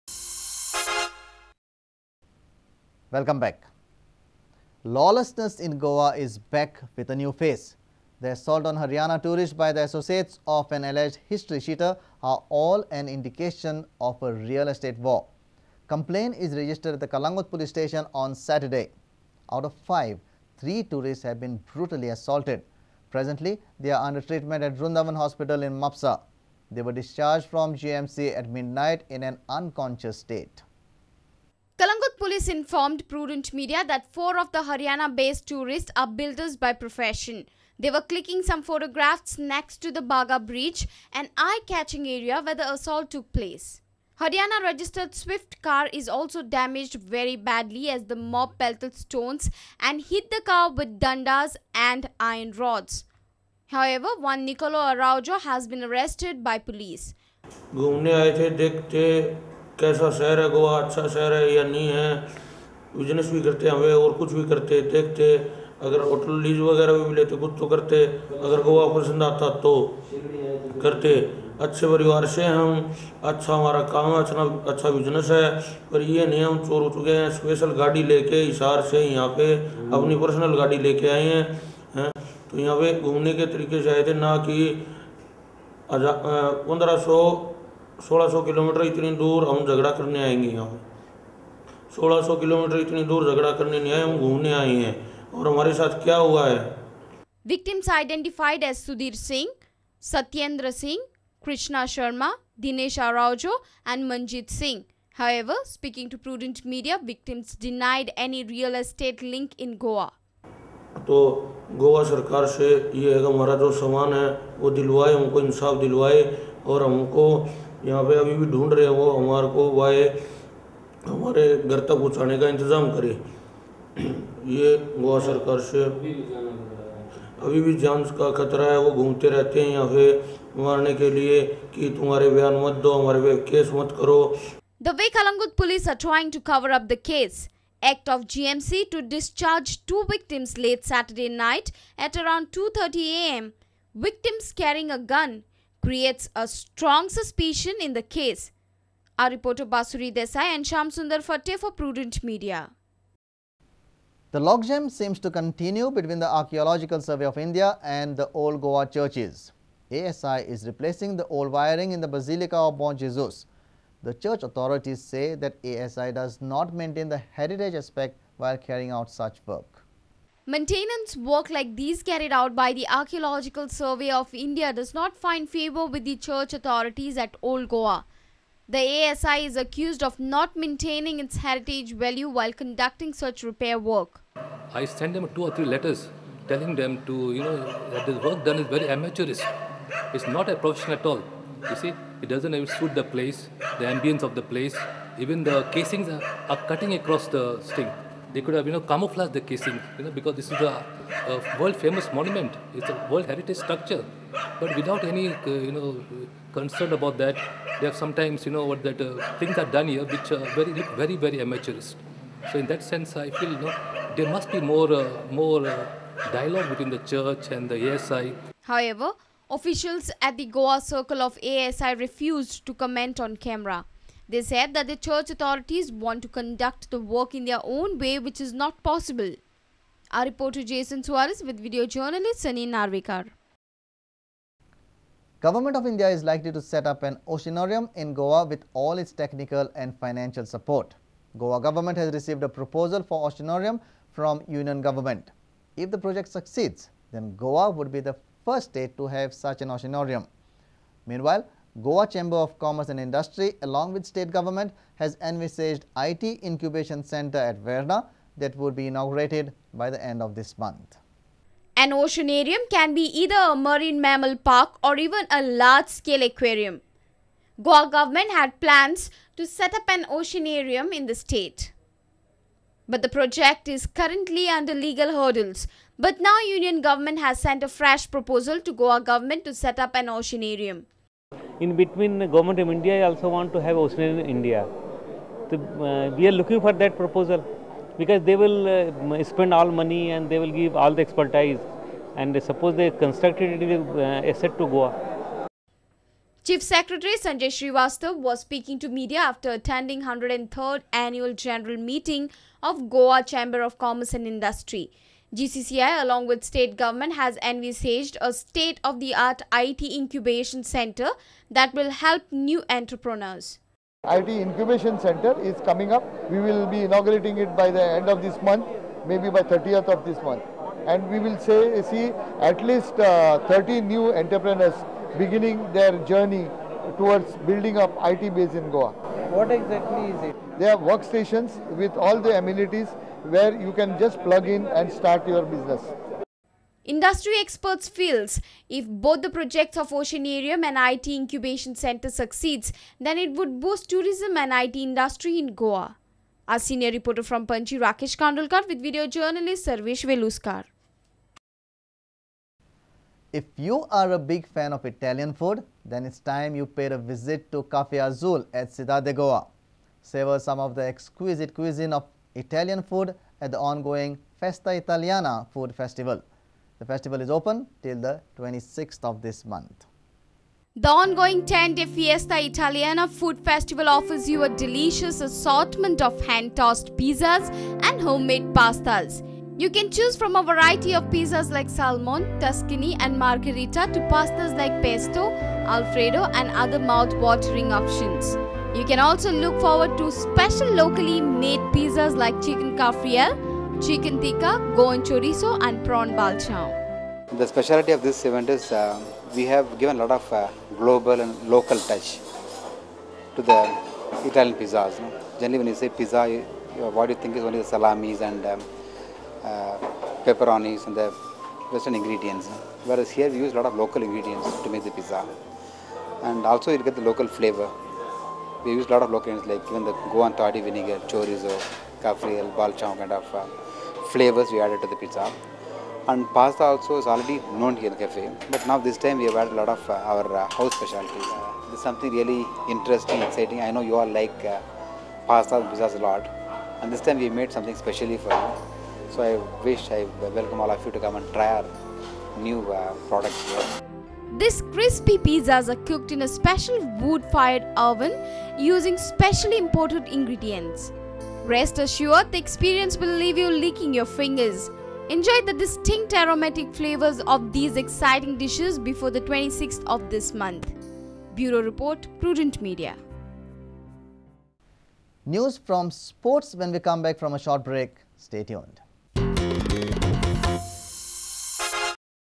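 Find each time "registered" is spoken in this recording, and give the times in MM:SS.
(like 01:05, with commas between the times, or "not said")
00:16, 00:44.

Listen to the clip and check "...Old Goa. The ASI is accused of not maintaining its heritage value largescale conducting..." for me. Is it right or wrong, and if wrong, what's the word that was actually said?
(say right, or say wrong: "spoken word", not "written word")
wrong: "while", not "largescale".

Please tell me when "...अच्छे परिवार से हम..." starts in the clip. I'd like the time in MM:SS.
01:11.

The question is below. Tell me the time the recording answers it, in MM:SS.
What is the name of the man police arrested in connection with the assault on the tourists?
00:54.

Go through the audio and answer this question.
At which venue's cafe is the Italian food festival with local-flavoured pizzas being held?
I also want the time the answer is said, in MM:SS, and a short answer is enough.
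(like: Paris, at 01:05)
Cidade de Goa, at 05:58.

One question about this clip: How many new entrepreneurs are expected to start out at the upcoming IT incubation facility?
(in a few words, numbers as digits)
30.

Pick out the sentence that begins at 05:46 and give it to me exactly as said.
Our senior reporter from Panjim, Rakesh Kandolkar with video journalist Sarvesh Veluskar.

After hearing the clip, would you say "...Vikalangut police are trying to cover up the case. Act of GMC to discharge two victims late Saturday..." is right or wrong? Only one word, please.
right.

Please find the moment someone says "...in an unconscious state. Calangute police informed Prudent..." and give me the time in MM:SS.
00:29.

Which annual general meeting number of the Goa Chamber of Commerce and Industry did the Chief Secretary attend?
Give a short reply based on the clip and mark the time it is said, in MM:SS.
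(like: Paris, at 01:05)
103rd, at 05:00.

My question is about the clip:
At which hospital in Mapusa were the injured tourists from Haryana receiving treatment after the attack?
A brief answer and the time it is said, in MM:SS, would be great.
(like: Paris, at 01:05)
Vrundavan Hospital, at 00:24.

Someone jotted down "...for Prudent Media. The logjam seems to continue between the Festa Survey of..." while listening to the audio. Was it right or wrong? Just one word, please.
wrong.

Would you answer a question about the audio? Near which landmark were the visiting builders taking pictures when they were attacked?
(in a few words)
Baga Bridge.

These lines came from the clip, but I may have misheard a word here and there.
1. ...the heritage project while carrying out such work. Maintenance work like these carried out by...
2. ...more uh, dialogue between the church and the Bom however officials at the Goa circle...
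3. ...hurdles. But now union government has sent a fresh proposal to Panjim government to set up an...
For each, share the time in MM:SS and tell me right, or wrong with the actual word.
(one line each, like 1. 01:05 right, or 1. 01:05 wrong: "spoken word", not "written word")
1. 02:47 wrong: "aspect", not "project"
2. 03:35 wrong: "ASI", not "Bom"
3. 04:35 wrong: "Goa", not "Panjim".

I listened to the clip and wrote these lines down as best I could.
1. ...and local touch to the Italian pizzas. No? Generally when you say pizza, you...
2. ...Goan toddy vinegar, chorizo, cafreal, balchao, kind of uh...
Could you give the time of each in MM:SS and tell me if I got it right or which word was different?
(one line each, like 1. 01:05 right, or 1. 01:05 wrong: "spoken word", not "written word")
1. 06:41 right
2. 07:00 right.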